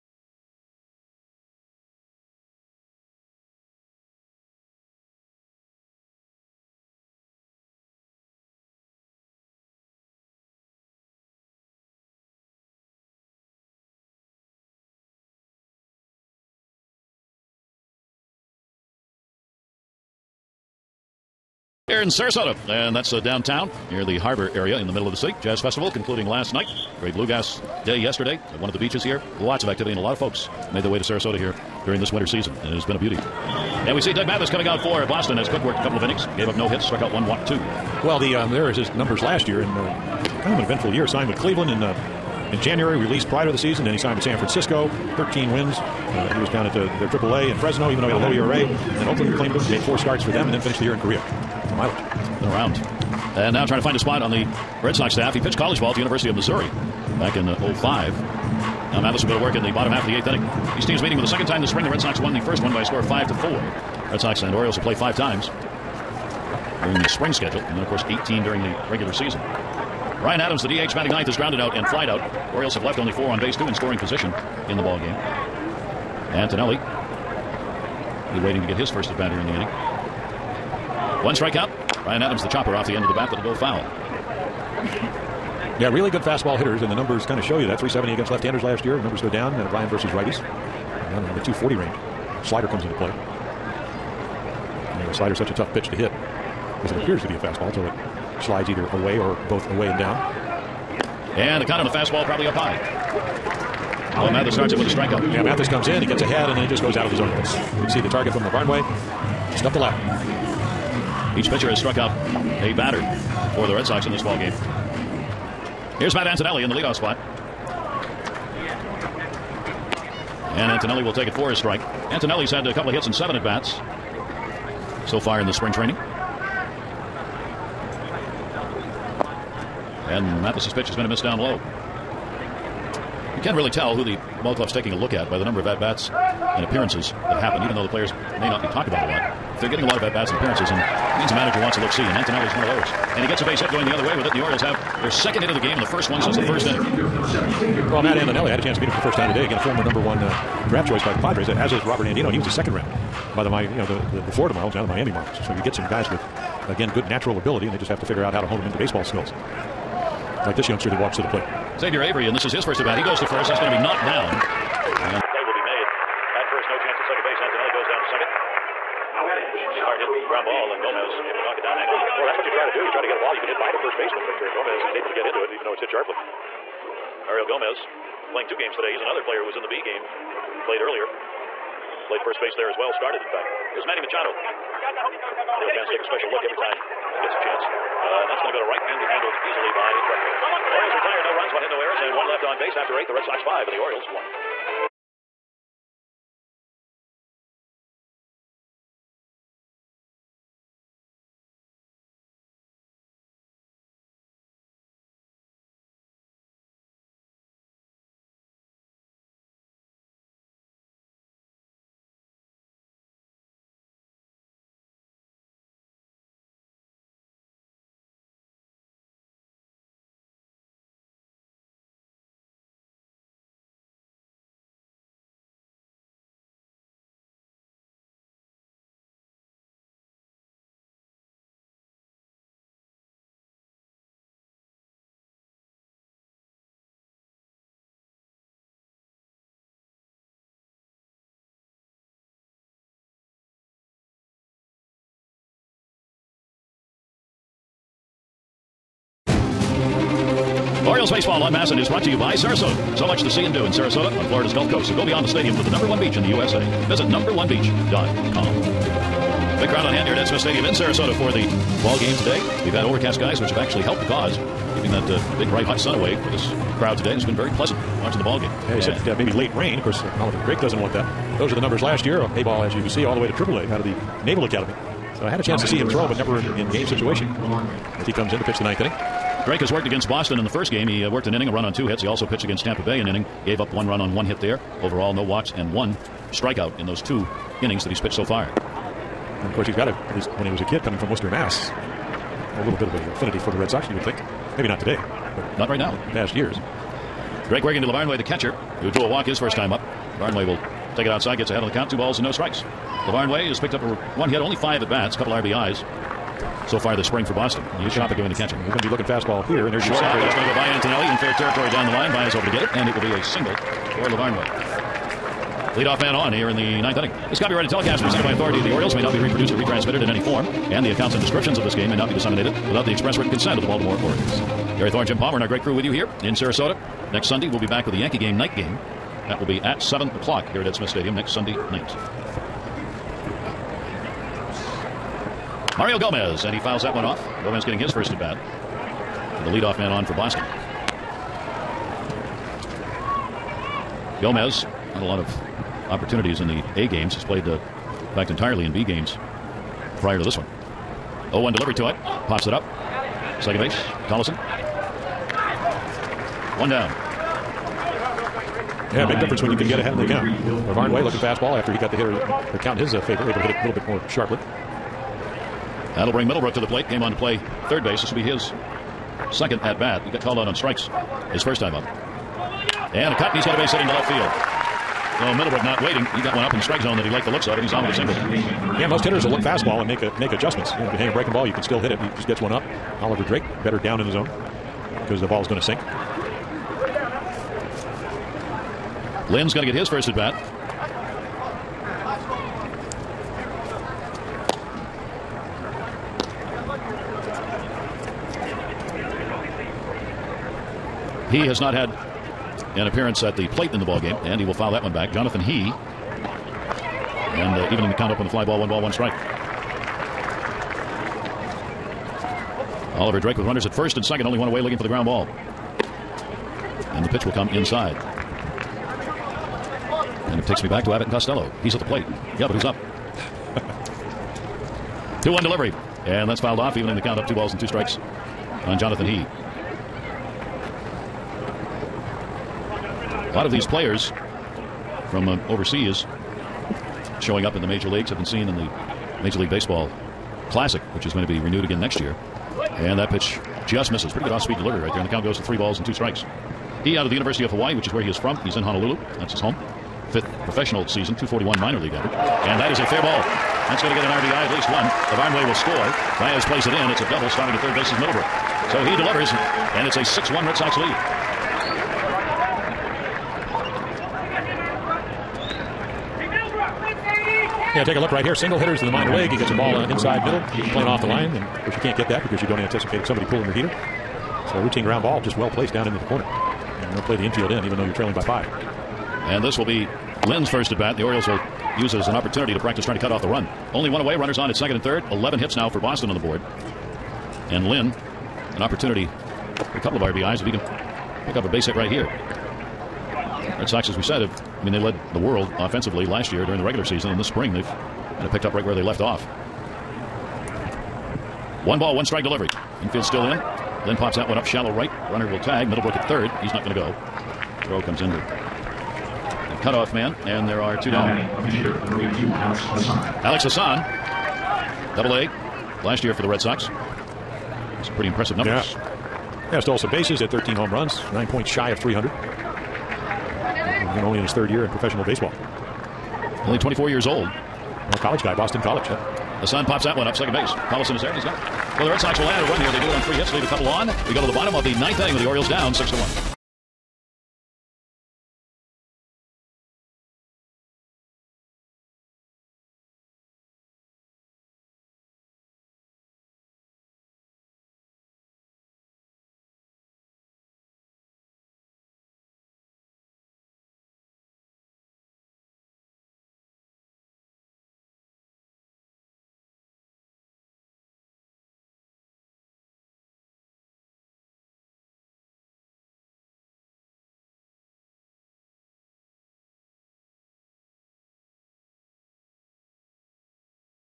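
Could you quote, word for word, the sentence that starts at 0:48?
Then Oakland claimed him, made four starts for them, and then finished the year in Korea.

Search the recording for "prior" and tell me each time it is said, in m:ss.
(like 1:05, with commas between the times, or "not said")
0:43, 5:50.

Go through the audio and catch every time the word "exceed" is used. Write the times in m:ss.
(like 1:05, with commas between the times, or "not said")
not said.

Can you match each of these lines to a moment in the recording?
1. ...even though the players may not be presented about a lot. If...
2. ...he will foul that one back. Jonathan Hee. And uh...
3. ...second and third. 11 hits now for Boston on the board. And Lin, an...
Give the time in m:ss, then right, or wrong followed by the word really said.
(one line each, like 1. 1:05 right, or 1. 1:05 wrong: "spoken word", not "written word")
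1. 2:17 wrong: "talked", not "presented"
2. 6:44 right
3. 8:04 right.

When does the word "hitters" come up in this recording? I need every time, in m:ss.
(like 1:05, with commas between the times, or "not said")
1:26, 6:01, 6:19, 7:48.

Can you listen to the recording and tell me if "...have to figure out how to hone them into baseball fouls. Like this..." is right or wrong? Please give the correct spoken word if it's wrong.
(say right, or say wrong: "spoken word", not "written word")
wrong: "skills", not "fouls".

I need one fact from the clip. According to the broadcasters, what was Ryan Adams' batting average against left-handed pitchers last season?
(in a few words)
370.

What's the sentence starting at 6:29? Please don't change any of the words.
Lin's going to get his first at bat.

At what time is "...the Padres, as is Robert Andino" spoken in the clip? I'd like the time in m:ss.
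2:31.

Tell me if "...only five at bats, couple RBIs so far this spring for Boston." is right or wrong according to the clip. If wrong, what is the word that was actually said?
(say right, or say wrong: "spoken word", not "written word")
right.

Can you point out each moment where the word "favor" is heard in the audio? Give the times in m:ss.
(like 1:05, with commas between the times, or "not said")
6:03.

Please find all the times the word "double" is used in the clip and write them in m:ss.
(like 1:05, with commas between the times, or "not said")
7:37, 8:34.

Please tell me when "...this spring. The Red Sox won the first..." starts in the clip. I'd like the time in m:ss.
1:01.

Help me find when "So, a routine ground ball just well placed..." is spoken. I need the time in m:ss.
7:54.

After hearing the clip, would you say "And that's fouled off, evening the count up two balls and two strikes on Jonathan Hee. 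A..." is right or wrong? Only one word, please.
right.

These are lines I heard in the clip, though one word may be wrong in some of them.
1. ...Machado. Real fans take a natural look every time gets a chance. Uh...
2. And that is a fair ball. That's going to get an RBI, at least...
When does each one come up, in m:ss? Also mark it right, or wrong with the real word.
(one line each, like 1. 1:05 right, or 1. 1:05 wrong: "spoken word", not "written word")
1. 3:03 wrong: "special", not "natural"
2. 7:32 right.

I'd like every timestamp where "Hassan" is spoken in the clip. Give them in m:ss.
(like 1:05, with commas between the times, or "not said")
8:33, 8:49.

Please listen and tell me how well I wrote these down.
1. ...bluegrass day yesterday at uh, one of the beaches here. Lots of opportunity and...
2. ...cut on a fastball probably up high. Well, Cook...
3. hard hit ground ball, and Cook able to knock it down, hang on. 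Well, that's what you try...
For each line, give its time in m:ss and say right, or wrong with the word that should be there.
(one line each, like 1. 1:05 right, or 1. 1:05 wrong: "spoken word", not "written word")
1. 0:27 wrong: "activity", not "opportunity"
2. 1:41 wrong: "Mathis", not "Cook"
3. 2:49 wrong: "Gomez", not "Cook".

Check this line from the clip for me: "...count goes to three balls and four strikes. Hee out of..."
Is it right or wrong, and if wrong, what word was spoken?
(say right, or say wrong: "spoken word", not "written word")
wrong: "two", not "four".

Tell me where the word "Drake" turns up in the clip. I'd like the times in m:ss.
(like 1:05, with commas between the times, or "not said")
4:30, 4:39, 4:57, 6:23, 6:53.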